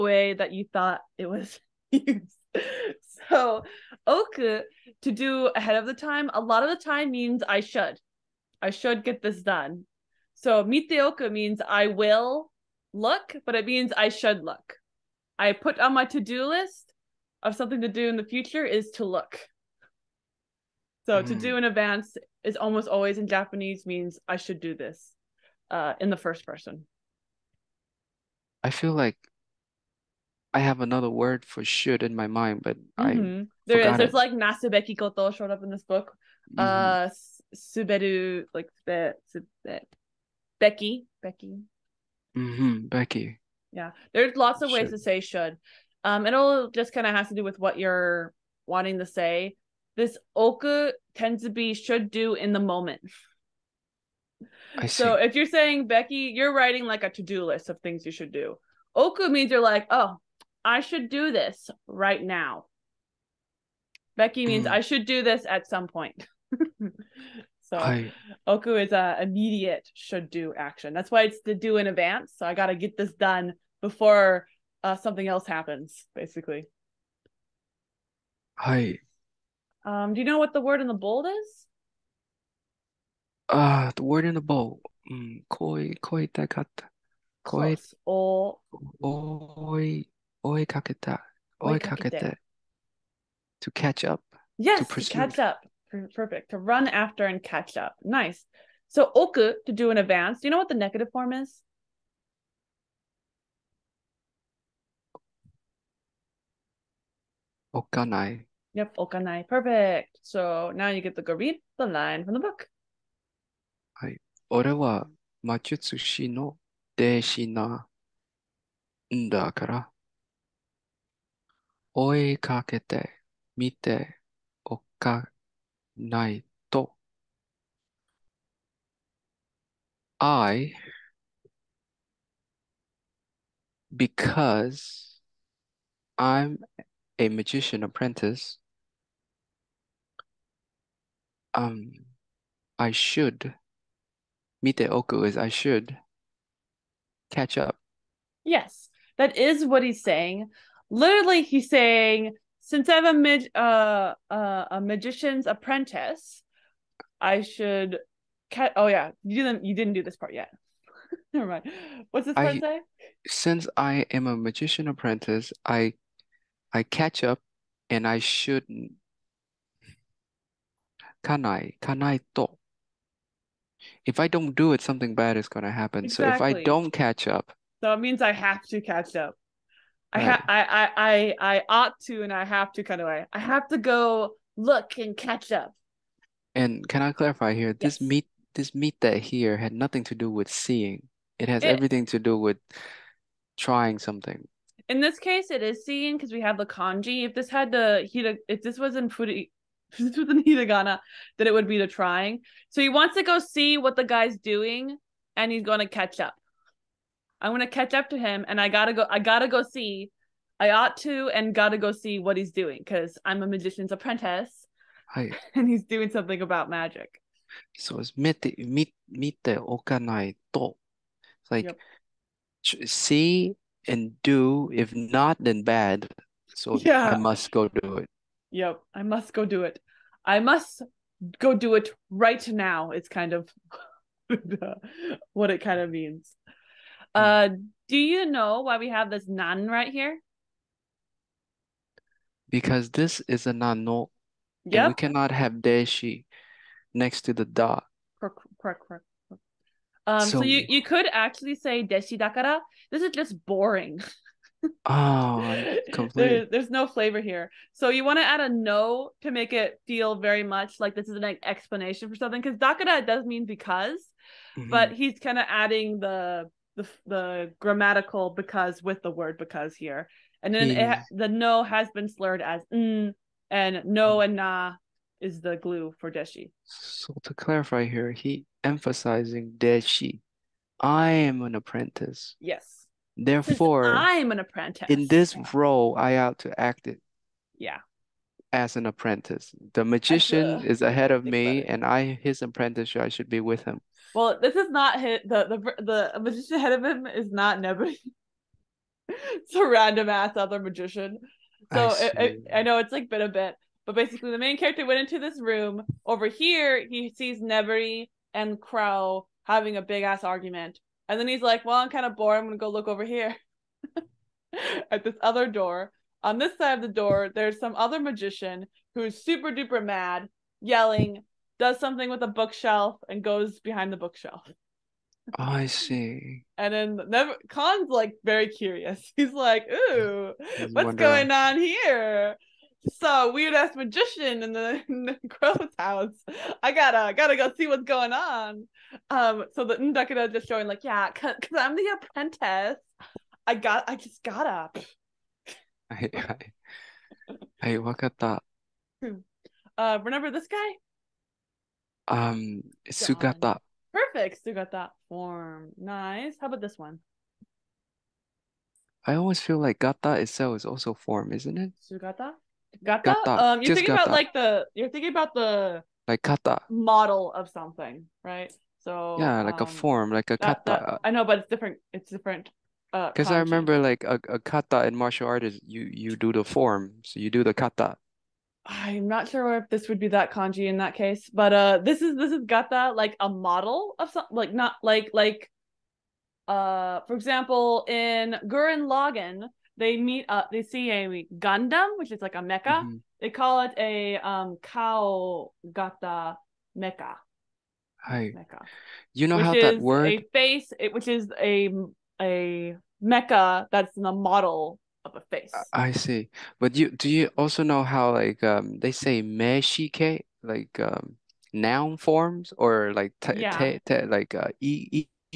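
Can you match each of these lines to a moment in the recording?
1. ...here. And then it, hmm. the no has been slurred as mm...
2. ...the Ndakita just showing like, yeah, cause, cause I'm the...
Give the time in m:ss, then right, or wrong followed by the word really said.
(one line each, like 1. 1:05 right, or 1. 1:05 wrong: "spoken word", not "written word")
1. 4:29 right
2. 5:39 right.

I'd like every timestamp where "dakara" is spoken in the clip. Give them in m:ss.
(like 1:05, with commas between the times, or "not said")
4:12, 4:22.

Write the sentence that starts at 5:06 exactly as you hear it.
Over here, he sees Nevery and Crowe having a big ass argument, and then he's like, "Well, I'm kind of bored.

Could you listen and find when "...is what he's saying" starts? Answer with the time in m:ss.
2:29.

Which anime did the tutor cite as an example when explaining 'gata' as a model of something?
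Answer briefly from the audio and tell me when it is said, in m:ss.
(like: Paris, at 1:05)
Gurren Lagann, at 6:28.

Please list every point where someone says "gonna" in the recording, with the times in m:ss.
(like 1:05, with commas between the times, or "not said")
2:55, 5:12.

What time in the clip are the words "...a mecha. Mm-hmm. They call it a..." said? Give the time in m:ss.
6:32.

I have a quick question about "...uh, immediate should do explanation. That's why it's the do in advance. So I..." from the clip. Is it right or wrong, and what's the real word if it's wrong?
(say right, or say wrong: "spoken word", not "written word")
wrong: "action", not "explanation".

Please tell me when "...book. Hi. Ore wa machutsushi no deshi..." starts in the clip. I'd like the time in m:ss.
1:52.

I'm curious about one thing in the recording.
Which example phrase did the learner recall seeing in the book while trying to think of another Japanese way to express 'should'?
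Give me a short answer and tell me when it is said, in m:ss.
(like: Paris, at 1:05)
nasubeki koto, at 0:34.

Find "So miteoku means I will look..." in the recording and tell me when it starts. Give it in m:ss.
0:10.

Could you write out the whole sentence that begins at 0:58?
Oku means you're like, oh, I should do this right now.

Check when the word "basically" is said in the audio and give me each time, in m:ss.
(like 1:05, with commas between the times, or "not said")
1:16, 5:03.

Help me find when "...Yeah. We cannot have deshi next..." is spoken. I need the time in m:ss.
4:04.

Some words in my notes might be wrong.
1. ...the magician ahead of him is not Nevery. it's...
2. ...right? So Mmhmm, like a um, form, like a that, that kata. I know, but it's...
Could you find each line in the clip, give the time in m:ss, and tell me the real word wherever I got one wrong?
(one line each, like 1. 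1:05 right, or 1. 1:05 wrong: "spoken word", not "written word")
1. 4:56 right
2. 6:08 wrong: "Yeah", not "Mmhmm".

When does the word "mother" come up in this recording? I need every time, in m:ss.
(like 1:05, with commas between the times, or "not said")
not said.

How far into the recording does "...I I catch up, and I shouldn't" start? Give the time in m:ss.
2:45.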